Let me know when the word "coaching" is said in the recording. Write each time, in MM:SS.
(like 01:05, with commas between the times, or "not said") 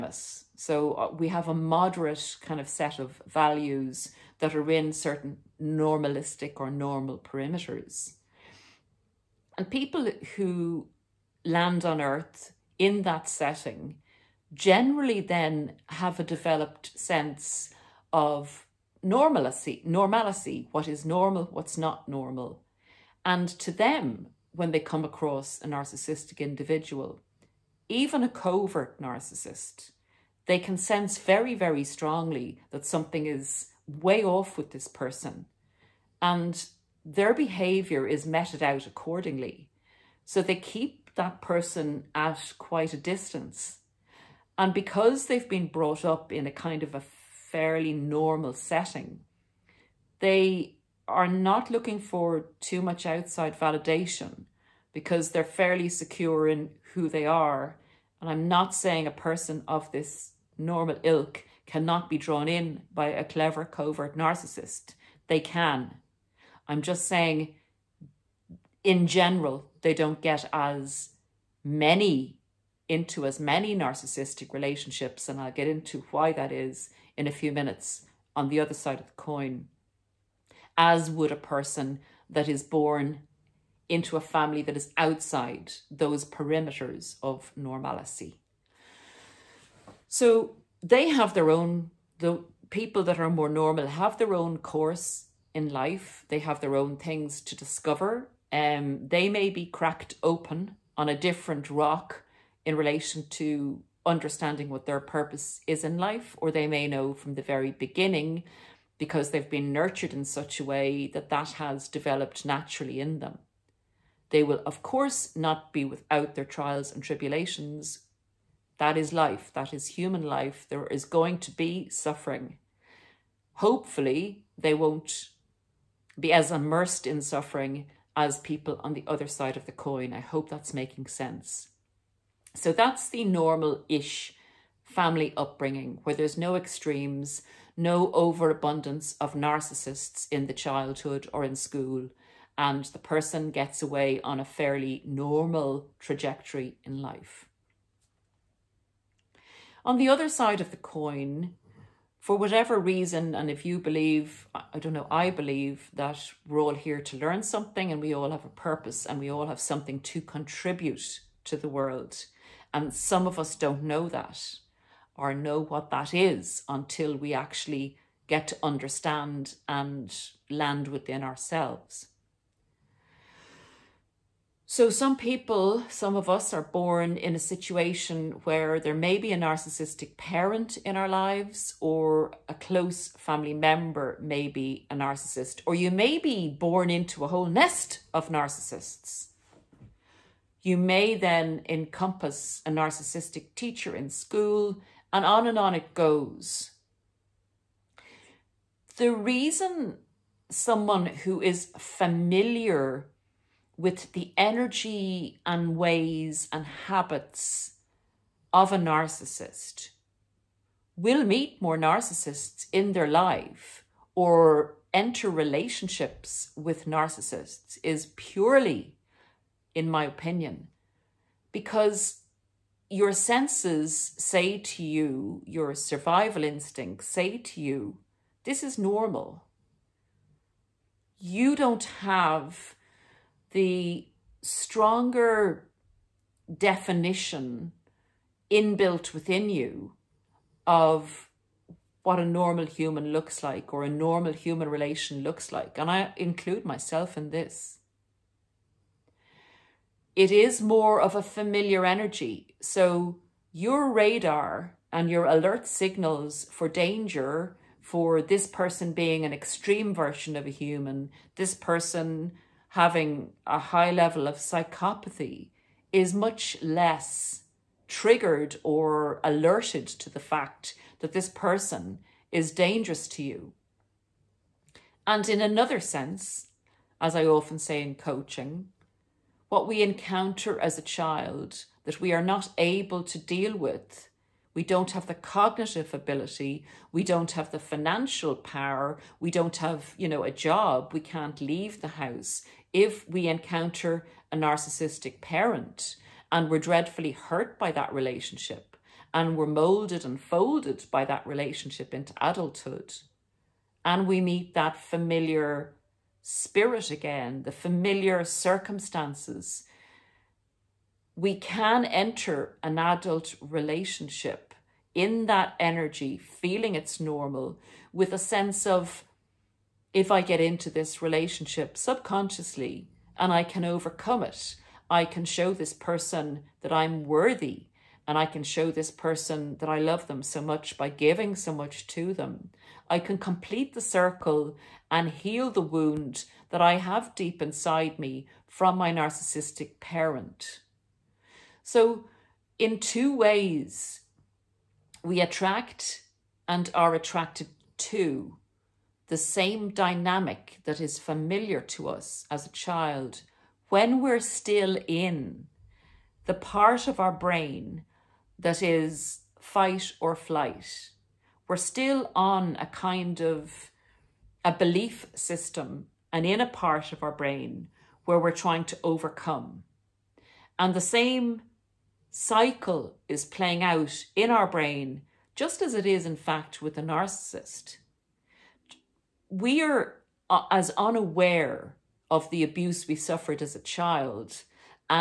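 04:37.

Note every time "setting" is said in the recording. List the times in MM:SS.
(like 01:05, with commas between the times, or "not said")
00:13, 00:48.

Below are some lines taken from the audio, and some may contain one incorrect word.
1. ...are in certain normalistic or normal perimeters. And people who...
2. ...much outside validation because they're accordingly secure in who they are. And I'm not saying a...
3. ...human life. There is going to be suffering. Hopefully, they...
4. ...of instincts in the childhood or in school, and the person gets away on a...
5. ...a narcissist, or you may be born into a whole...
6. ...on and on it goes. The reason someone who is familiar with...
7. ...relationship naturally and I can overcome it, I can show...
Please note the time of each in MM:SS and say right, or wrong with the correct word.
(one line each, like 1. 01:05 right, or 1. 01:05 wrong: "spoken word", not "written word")
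1. 00:04 right
2. 00:52 wrong: "fairly", not "accordingly"
3. 01:59 right
4. 02:19 wrong: "narcissists", not "instincts"
5. 03:04 right
6. 03:15 right
7. 05:21 wrong: "subconsciously", not "naturally".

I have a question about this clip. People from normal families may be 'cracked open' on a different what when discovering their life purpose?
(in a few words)
rock.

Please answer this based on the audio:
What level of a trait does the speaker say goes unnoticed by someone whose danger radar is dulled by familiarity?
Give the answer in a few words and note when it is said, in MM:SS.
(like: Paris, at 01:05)
psychopathy, at 04:24.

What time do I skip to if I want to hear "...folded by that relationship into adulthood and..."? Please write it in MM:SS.
05:00.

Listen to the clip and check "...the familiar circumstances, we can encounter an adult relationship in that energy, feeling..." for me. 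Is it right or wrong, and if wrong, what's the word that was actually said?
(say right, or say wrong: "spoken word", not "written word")
wrong: "enter", not "encounter".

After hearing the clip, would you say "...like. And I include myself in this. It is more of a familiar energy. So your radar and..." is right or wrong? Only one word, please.
right.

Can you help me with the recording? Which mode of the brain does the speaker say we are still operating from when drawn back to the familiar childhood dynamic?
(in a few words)
fight or flight.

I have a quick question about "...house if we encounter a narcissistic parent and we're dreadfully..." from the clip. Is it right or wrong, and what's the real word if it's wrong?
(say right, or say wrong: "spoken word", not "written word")
right.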